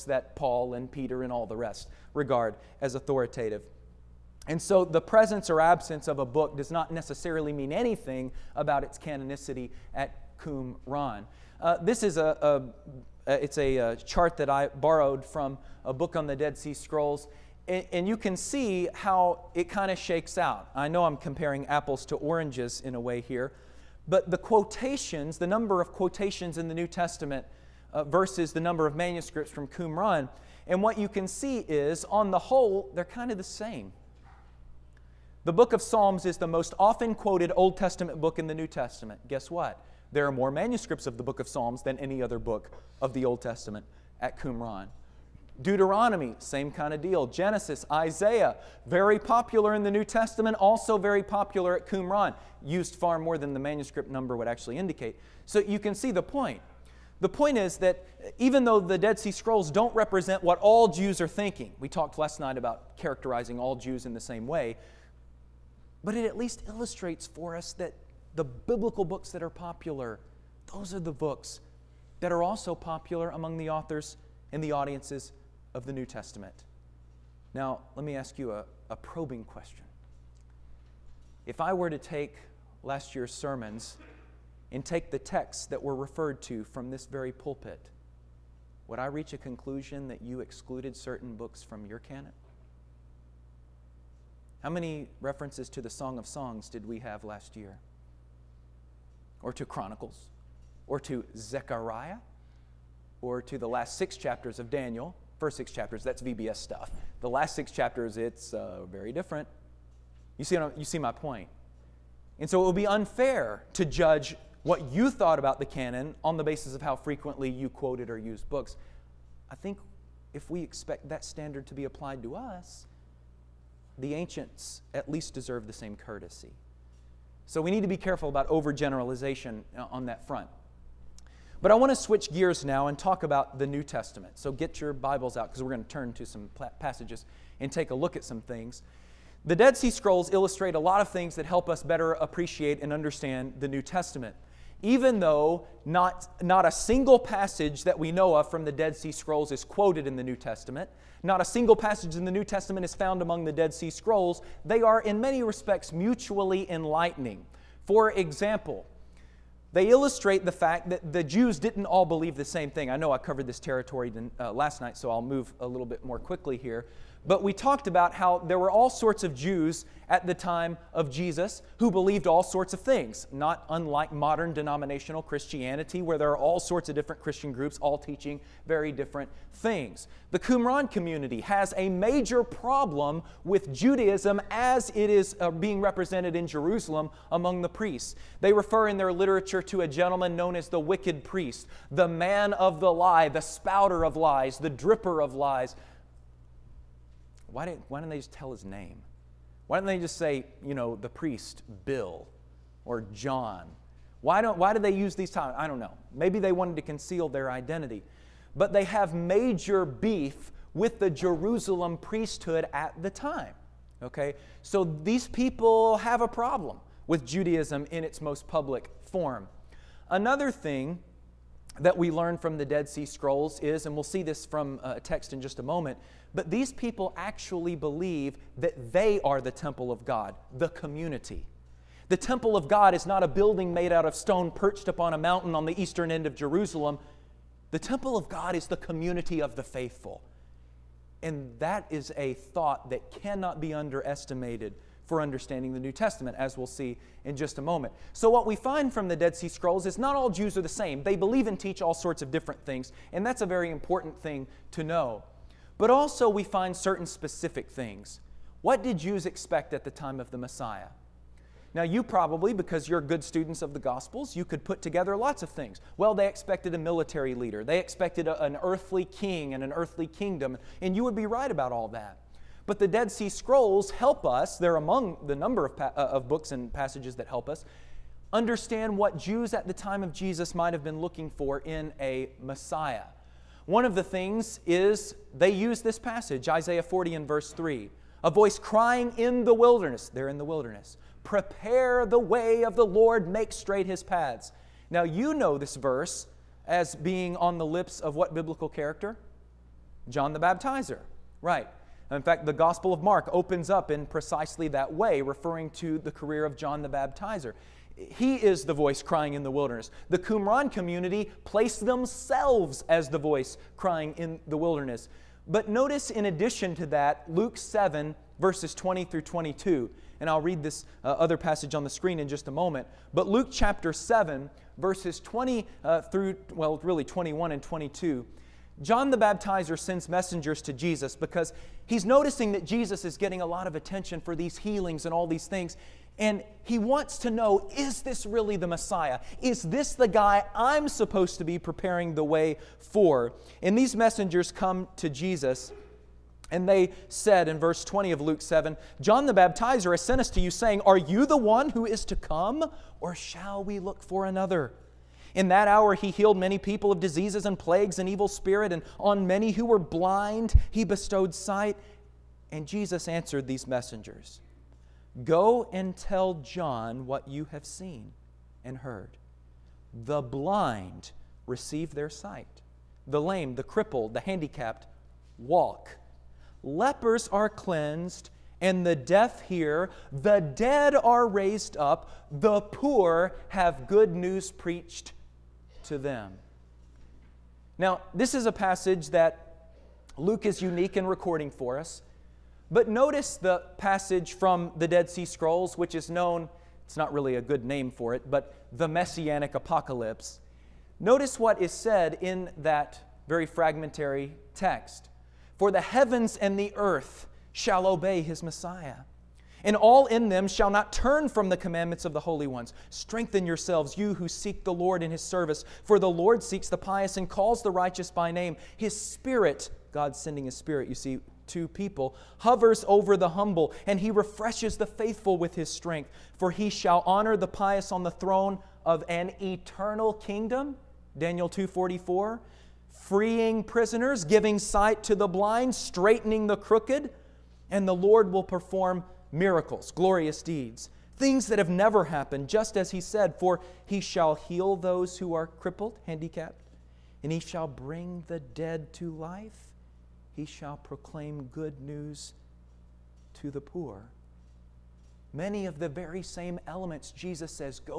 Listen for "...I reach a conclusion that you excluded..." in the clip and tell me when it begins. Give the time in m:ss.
1:28.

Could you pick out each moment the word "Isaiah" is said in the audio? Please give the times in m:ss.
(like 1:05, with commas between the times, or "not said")
0:47, 4:46.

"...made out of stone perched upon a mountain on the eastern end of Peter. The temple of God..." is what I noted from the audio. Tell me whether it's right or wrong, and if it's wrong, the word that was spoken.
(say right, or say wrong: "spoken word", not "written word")
wrong: "Jerusalem", not "Peter".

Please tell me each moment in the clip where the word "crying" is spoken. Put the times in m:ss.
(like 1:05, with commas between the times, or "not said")
4:48, 5:09, 5:13.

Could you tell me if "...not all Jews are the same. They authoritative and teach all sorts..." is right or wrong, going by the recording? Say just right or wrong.
wrong.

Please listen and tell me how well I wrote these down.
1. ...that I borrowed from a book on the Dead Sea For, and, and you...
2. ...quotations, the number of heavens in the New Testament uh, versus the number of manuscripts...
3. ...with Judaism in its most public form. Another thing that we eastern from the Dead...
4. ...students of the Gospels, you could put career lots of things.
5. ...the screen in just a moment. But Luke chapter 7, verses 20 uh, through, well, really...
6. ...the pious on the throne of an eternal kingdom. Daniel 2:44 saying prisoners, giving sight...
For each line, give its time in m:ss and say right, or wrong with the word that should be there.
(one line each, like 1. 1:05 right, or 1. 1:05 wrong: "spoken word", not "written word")
1. 0:14 wrong: "Scrolls", not "For"
2. 0:24 wrong: "quotations", not "heavens"
3. 3:37 wrong: "learn", not "eastern"
4. 4:23 wrong: "together", not "career"
5. 5:21 right
6. 7:07 wrong: "freeing", not "saying".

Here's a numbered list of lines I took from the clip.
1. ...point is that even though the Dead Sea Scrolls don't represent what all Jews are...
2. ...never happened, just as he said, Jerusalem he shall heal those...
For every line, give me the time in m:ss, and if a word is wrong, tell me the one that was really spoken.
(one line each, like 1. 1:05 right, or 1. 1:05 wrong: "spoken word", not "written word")
1. 0:57 right
2. 7:21 wrong: "For", not "Jerusalem".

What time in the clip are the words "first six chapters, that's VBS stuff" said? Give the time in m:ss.
1:45.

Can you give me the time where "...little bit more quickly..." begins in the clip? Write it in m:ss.
2:45.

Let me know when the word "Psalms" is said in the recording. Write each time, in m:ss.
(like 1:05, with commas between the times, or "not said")
0:35, 0:41.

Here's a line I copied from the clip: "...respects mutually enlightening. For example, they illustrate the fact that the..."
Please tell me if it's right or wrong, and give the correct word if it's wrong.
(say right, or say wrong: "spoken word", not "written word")
right.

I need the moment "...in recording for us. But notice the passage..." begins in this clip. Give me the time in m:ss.
6:30.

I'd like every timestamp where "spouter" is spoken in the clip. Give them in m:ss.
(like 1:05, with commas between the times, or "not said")
3:13.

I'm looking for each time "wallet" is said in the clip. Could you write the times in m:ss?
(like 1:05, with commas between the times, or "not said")
not said.